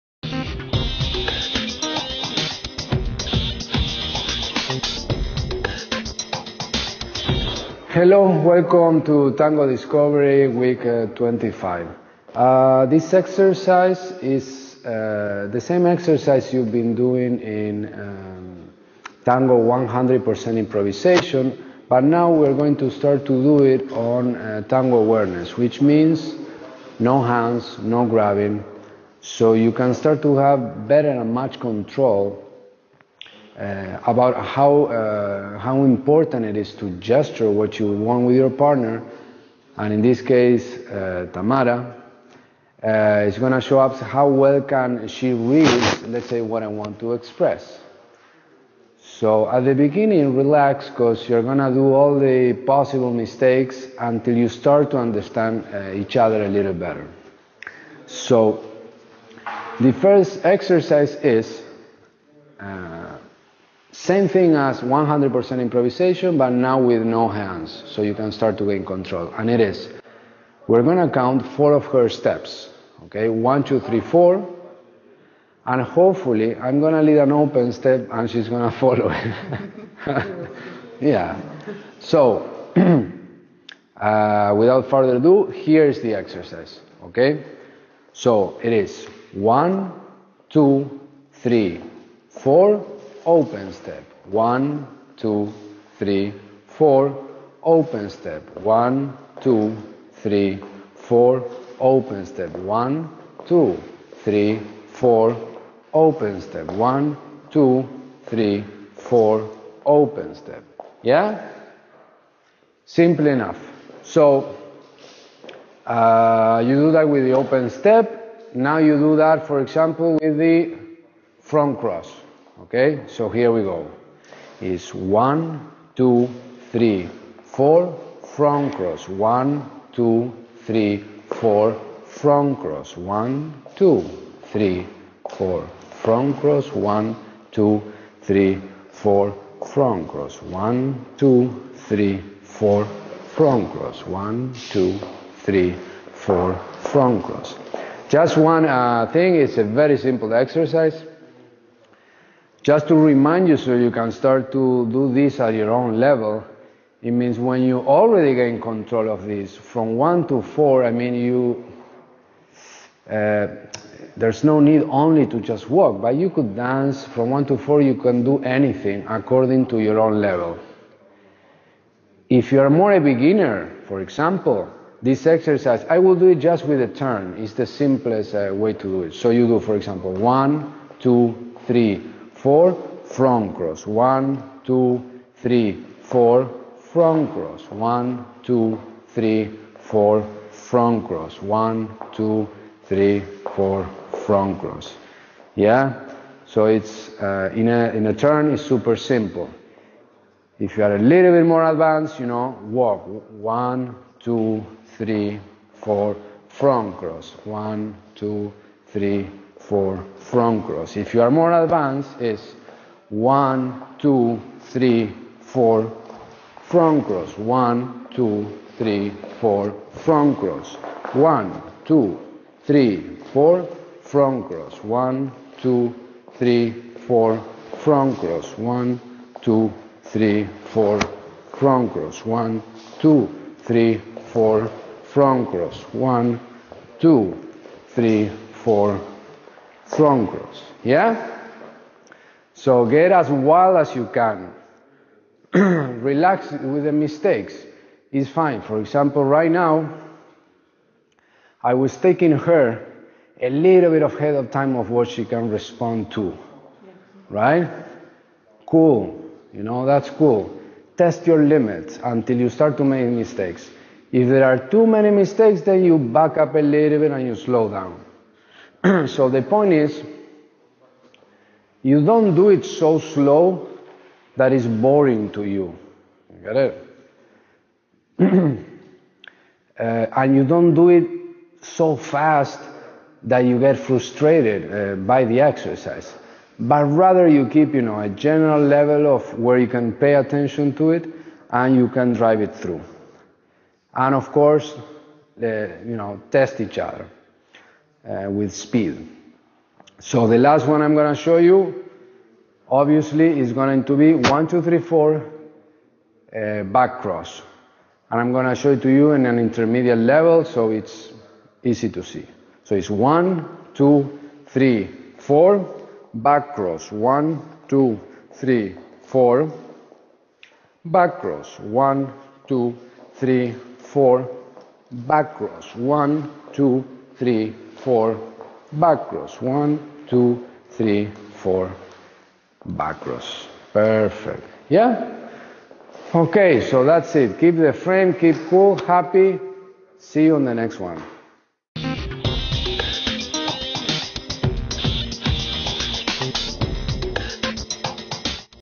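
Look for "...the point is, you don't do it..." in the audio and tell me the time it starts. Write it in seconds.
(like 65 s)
269 s.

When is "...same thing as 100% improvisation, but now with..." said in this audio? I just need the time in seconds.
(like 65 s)
63 s.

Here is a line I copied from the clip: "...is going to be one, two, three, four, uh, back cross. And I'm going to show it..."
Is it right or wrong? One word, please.
right.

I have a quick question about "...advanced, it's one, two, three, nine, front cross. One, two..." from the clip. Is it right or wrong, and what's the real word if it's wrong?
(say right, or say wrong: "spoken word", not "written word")
wrong: "four", not "nine".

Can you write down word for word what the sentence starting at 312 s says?
So it's one, two, three, four, back cross.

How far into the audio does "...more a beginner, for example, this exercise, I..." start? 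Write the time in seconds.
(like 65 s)
172 s.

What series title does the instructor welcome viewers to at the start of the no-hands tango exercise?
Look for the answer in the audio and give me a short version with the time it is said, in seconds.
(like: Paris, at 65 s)
Tango Discovery Week, at 9 s.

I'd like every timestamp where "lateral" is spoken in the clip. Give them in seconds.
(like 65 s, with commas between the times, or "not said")
not said.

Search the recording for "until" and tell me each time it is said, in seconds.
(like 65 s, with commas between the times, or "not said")
53 s, 262 s.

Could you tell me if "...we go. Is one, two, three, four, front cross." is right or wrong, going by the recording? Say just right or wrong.
right.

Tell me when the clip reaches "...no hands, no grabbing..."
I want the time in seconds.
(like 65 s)
26 s.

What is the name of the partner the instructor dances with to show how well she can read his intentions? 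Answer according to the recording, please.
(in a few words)
Tamara.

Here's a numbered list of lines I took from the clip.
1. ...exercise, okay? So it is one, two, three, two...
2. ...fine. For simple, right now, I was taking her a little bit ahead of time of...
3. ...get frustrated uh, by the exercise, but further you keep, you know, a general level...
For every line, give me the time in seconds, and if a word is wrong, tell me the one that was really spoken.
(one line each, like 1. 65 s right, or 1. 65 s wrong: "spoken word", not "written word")
1. 86 s wrong: "four", not "two"
2. 248 s wrong: "example", not "simple"
3. 283 s wrong: "rather", not "further".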